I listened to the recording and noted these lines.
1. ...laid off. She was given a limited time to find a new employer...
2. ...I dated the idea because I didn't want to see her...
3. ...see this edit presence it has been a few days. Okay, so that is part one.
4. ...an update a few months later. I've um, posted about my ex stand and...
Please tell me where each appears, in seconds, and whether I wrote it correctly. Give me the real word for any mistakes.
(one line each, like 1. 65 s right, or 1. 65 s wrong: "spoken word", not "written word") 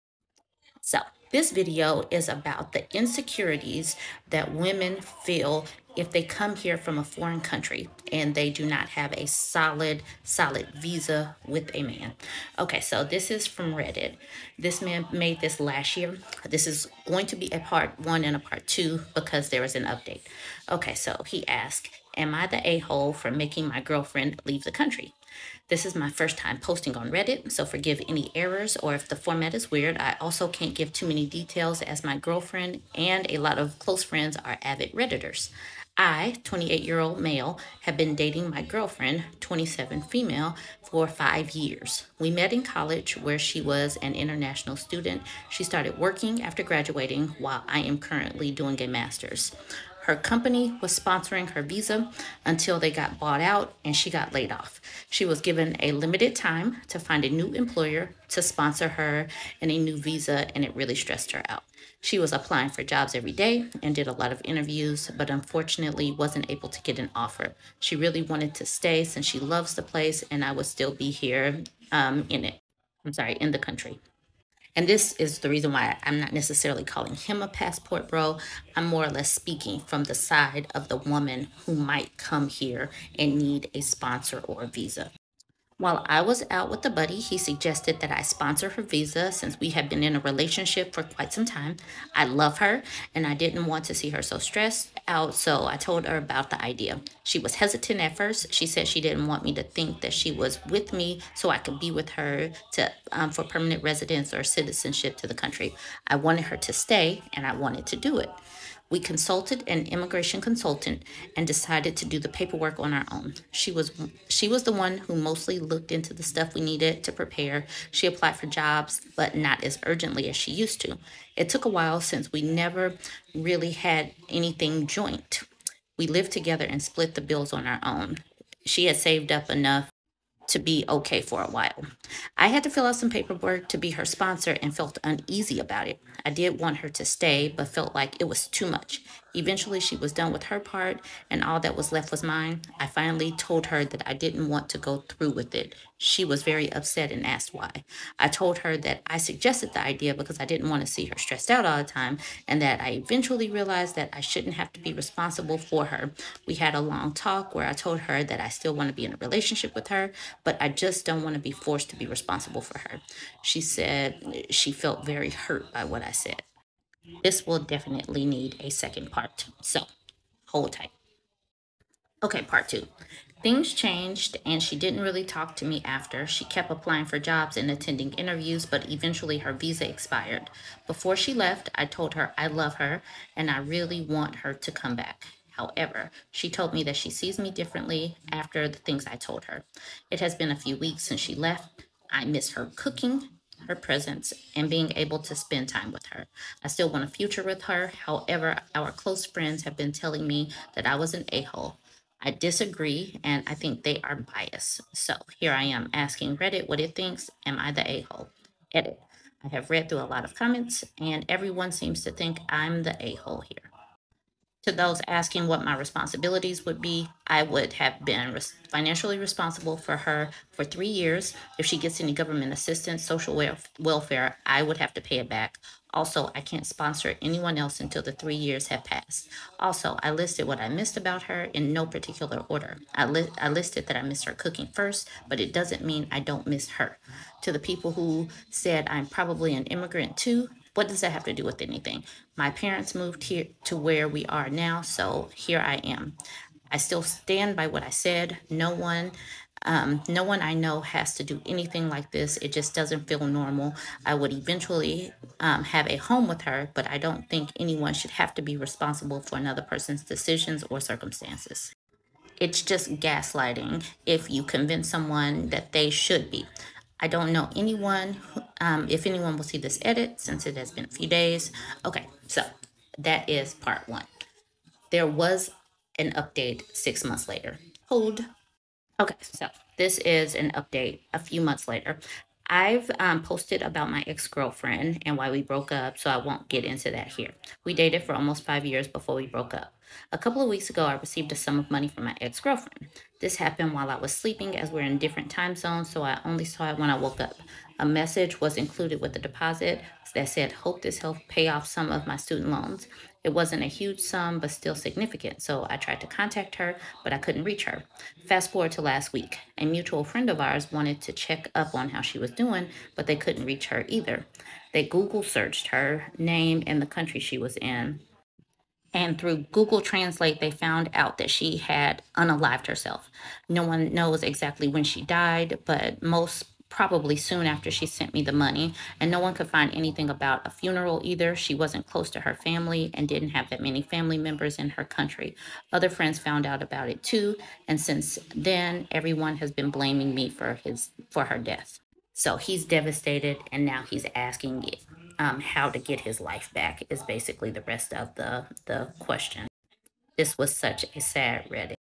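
1. 54 s right
2. 149 s wrong: "suggested", not "dated"
3. 269 s wrong: "since", not "presence"
4. 280 s wrong: "girlfriend", not "stand".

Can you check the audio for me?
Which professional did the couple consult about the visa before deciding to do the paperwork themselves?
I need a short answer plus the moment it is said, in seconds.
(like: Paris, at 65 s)
An immigration consultant, at 109 s.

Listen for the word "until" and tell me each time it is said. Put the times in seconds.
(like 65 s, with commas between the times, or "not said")
52 s, 227 s.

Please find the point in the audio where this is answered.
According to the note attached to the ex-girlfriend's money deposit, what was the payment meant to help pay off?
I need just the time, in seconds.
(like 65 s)
302 s.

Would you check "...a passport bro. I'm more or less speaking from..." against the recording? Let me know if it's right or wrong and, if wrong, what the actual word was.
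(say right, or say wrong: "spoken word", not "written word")
right.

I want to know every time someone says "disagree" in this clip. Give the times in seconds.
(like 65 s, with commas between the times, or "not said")
202 s.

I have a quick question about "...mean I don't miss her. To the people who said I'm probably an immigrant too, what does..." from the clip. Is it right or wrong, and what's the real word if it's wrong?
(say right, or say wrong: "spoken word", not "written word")
right.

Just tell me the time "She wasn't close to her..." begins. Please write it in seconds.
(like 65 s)
331 s.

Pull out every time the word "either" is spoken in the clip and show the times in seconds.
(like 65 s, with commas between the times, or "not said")
313 s, 331 s.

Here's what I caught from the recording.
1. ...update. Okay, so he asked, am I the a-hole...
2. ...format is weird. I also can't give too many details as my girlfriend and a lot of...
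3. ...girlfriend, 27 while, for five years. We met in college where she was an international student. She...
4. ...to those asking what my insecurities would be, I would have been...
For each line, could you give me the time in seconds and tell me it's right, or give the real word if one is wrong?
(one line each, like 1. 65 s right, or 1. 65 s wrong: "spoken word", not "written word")
1. 19 s right
2. 29 s right
3. 38 s wrong: "female", not "while"
4. 214 s wrong: "responsibilities", not "insecurities".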